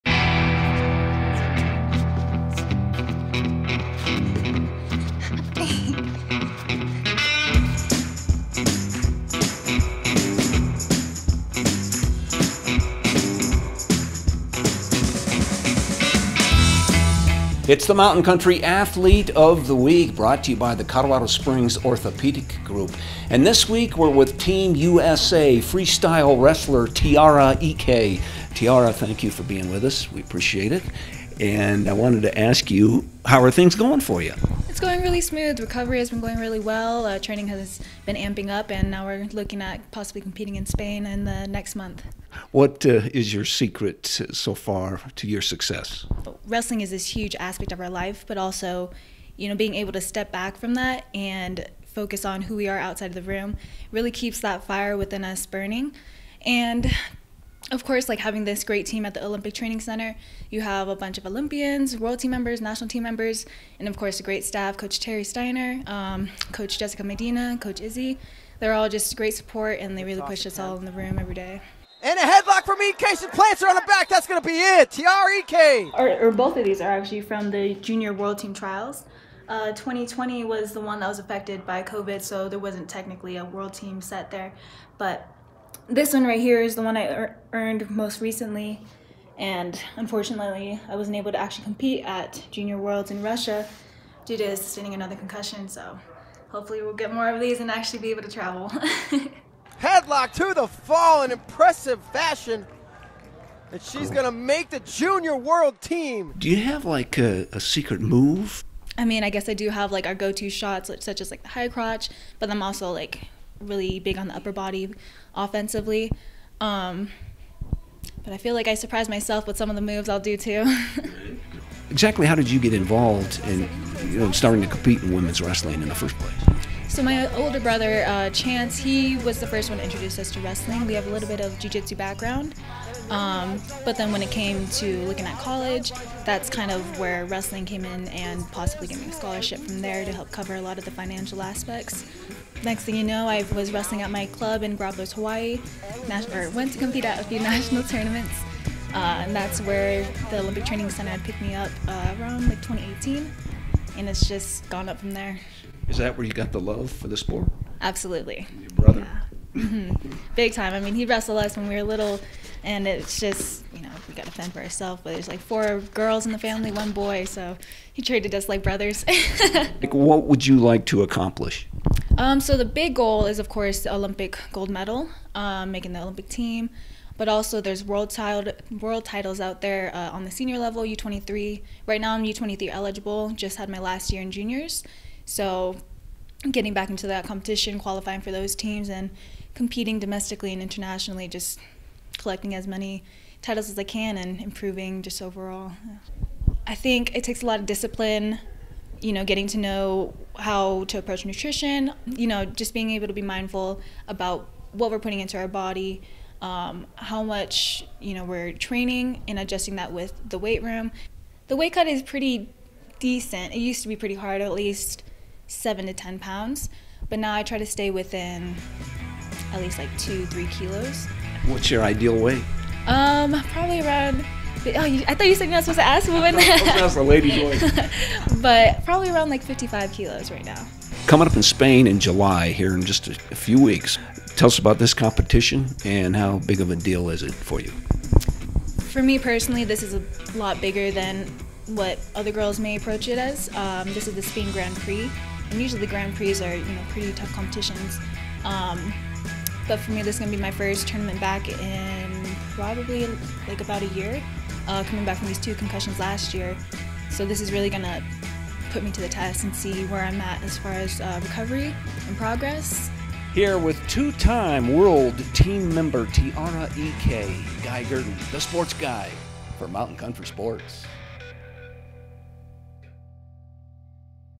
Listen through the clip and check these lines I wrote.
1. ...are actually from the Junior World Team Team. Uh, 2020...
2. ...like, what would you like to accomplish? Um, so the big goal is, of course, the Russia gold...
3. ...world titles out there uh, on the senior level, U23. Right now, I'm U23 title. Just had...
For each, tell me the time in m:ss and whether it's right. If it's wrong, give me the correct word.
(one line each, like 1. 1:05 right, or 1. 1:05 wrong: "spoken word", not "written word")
1. 1:16 wrong: "Trials", not "Team"
2. 2:49 wrong: "Olympic", not "Russia"
3. 2:58 wrong: "eligible", not "title".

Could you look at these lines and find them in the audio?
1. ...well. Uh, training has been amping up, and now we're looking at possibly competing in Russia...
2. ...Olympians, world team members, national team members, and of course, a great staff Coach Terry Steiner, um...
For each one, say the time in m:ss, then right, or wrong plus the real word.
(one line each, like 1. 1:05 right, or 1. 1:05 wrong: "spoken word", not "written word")
1. 0:36 wrong: "Spain", not "Russia"
2. 1:01 right.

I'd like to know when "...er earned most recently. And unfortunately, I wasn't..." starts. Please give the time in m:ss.
1:27.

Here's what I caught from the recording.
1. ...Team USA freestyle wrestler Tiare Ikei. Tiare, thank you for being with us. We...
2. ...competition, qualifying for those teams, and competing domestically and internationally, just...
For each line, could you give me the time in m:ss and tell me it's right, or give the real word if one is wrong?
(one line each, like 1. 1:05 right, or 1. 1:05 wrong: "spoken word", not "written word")
1. 0:24 right
2. 3:07 right.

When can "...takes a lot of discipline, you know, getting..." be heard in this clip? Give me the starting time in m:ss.
3:17.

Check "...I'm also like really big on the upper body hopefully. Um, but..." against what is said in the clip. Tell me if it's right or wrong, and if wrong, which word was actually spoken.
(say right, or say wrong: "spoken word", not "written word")
wrong: "offensively", not "hopefully".